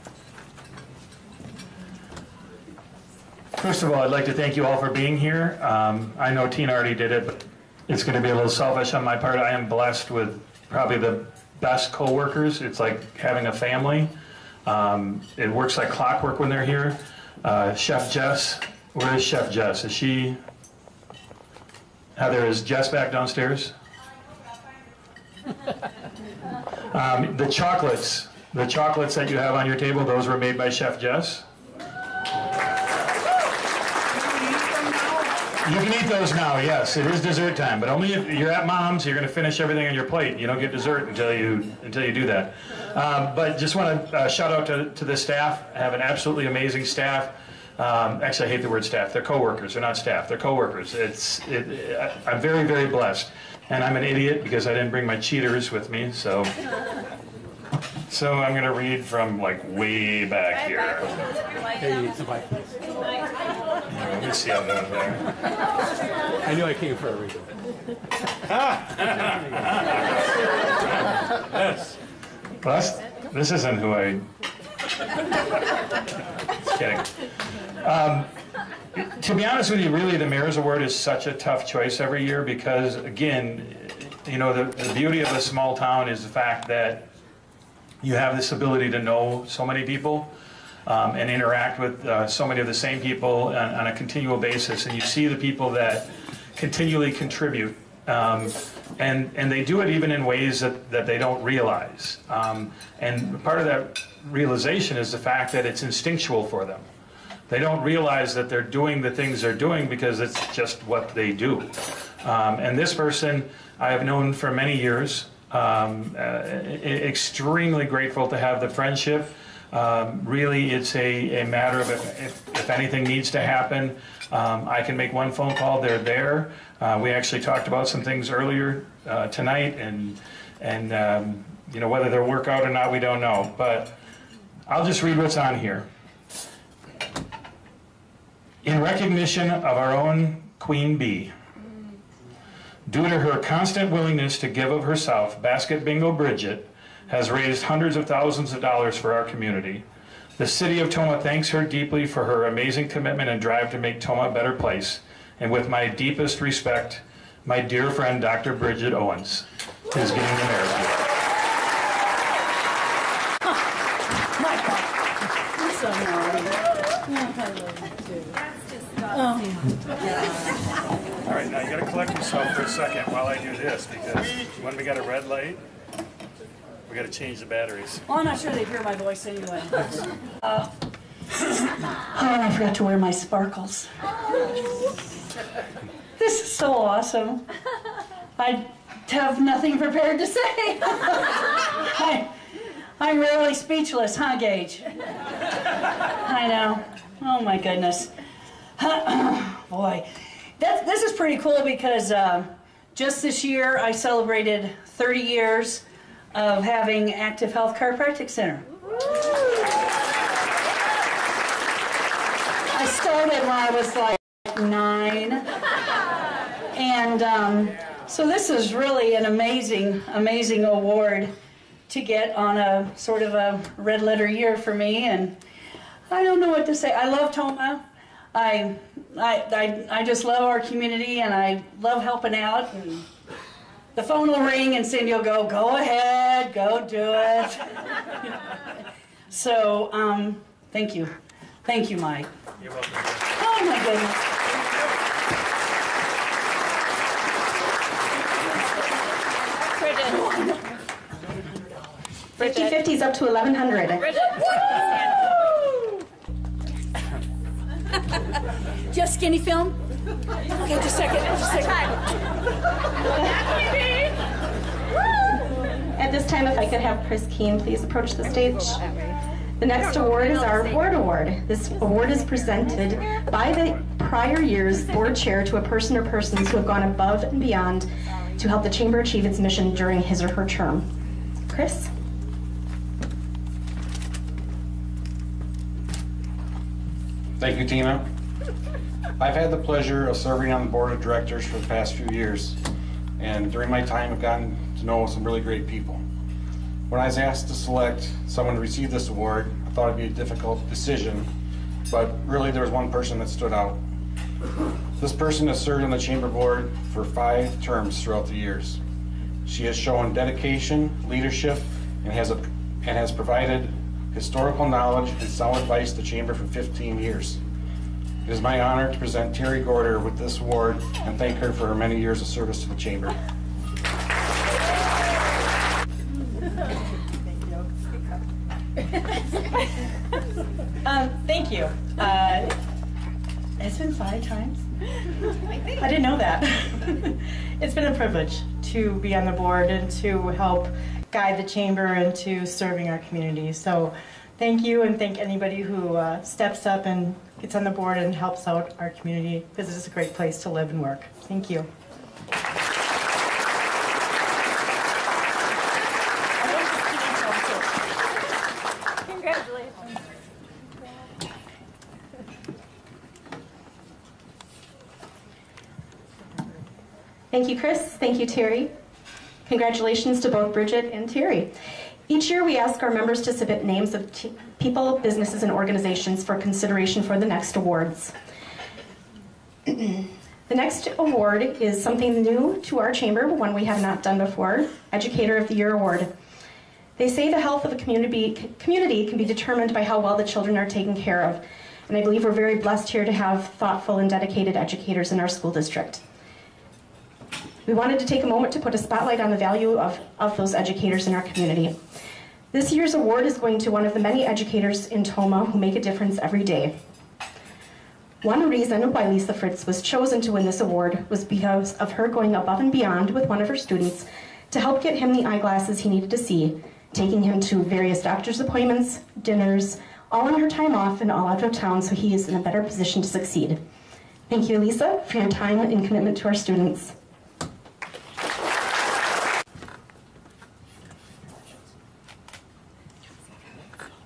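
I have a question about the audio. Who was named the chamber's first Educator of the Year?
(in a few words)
Lisa Fritz.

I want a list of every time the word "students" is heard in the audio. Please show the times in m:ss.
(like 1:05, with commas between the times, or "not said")
6:53, 7:06.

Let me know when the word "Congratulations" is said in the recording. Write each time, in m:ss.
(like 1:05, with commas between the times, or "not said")
5:59, 6:09.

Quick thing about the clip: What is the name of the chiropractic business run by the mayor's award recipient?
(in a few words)
Active Health Chiropractic Center.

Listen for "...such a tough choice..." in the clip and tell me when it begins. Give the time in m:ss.
1:20.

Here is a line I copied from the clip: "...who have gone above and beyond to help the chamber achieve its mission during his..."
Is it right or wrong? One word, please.
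right.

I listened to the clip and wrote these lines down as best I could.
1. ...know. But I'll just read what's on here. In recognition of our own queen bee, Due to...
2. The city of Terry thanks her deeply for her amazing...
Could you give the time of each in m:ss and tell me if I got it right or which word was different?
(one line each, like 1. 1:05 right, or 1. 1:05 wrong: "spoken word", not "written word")
1. 2:13 right
2. 2:30 wrong: "Tomah", not "Terry".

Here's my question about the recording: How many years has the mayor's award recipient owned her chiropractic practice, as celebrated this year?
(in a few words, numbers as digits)
30.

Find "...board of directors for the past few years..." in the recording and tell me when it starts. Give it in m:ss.
4:50.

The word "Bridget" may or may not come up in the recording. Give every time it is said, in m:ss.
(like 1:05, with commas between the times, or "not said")
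2:26, 2:38, 6:10.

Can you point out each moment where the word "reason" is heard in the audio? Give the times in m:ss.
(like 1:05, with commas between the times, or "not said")
1:07, 6:48.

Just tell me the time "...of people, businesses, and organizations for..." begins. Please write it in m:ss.
6:13.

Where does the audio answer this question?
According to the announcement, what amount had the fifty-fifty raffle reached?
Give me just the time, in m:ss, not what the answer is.
4:13.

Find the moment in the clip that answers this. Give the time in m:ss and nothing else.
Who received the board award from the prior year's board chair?
5:19.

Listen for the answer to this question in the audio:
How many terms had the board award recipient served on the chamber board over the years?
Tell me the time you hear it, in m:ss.
5:07.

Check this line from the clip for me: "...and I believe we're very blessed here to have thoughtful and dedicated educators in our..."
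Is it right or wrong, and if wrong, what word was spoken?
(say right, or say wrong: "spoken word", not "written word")
right.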